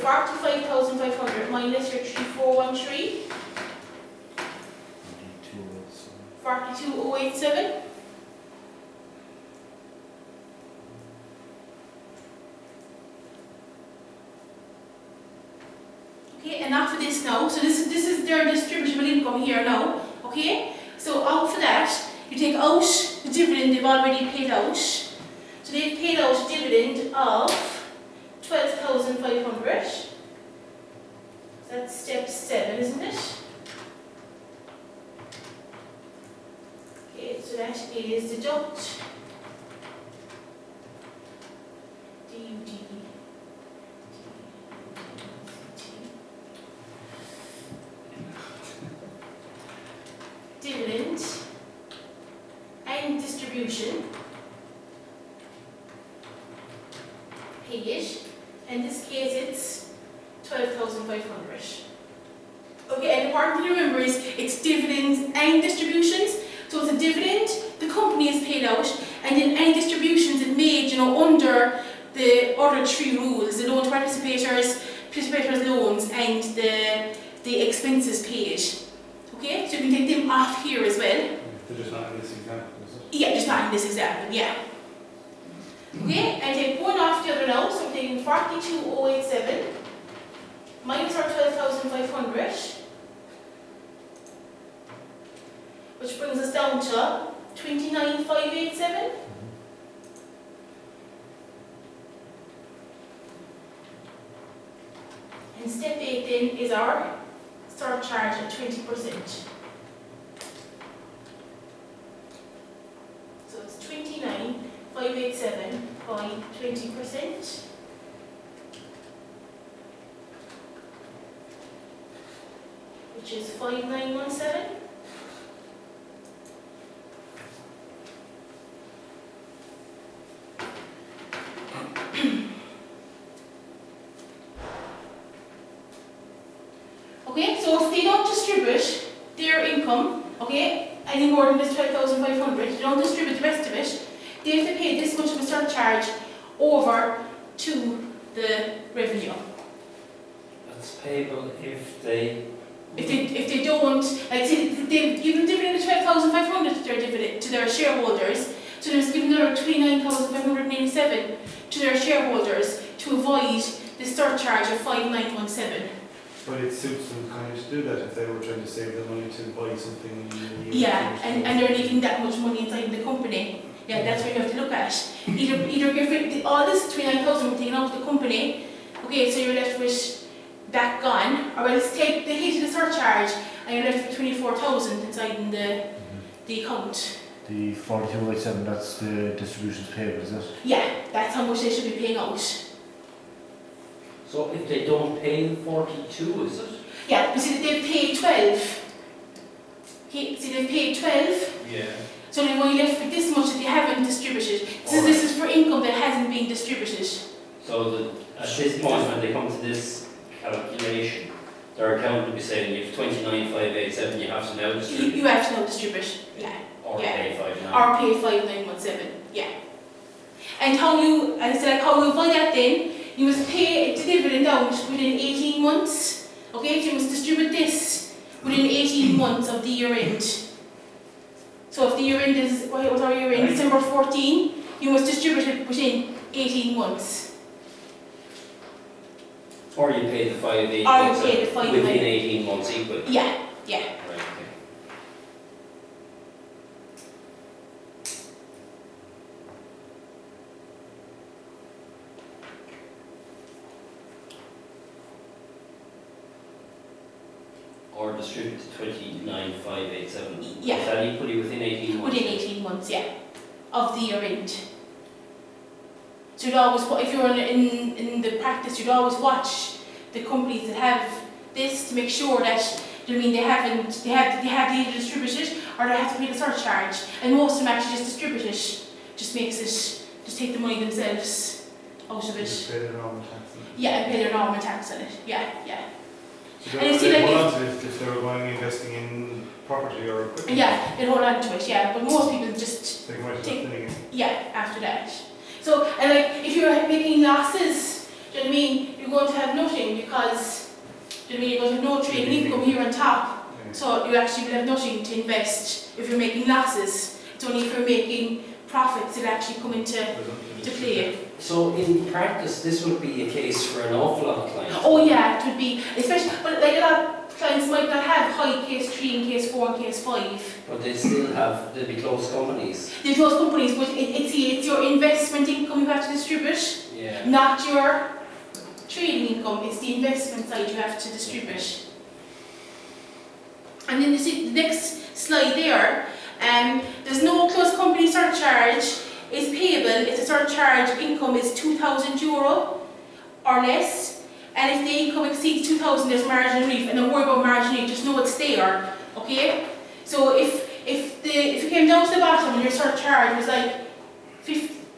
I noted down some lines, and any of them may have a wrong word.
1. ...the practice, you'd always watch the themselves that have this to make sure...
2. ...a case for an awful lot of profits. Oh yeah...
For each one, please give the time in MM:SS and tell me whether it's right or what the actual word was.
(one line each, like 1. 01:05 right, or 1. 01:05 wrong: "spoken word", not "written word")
1. 04:28 wrong: "companies", not "themselves"
2. 05:13 wrong: "clients", not "profits".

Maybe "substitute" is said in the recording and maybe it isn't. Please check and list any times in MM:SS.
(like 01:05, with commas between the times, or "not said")
not said.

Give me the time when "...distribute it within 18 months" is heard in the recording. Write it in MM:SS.
03:55.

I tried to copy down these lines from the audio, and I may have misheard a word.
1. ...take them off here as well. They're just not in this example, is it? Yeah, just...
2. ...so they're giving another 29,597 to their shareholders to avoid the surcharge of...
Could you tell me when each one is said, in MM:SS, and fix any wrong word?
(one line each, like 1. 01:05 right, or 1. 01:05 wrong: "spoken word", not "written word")
1. 01:20 right
2. 02:38 right.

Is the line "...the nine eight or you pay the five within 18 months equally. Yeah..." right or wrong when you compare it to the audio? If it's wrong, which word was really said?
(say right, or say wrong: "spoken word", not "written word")
wrong: "five", not "nine".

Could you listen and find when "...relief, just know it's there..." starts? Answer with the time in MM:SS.
05:47.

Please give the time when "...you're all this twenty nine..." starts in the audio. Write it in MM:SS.
02:55.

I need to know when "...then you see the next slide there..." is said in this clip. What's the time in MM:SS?
05:34.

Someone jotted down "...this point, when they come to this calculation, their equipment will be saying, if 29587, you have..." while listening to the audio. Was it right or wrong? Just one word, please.
wrong.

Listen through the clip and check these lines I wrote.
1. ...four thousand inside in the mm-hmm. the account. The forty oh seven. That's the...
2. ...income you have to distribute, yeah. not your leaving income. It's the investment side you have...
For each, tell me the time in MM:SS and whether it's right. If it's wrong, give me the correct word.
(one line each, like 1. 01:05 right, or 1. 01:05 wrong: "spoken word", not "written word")
1. 03:04 right
2. 05:25 wrong: "trading", not "leaving".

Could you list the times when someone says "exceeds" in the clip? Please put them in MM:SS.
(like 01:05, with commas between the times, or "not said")
05:45.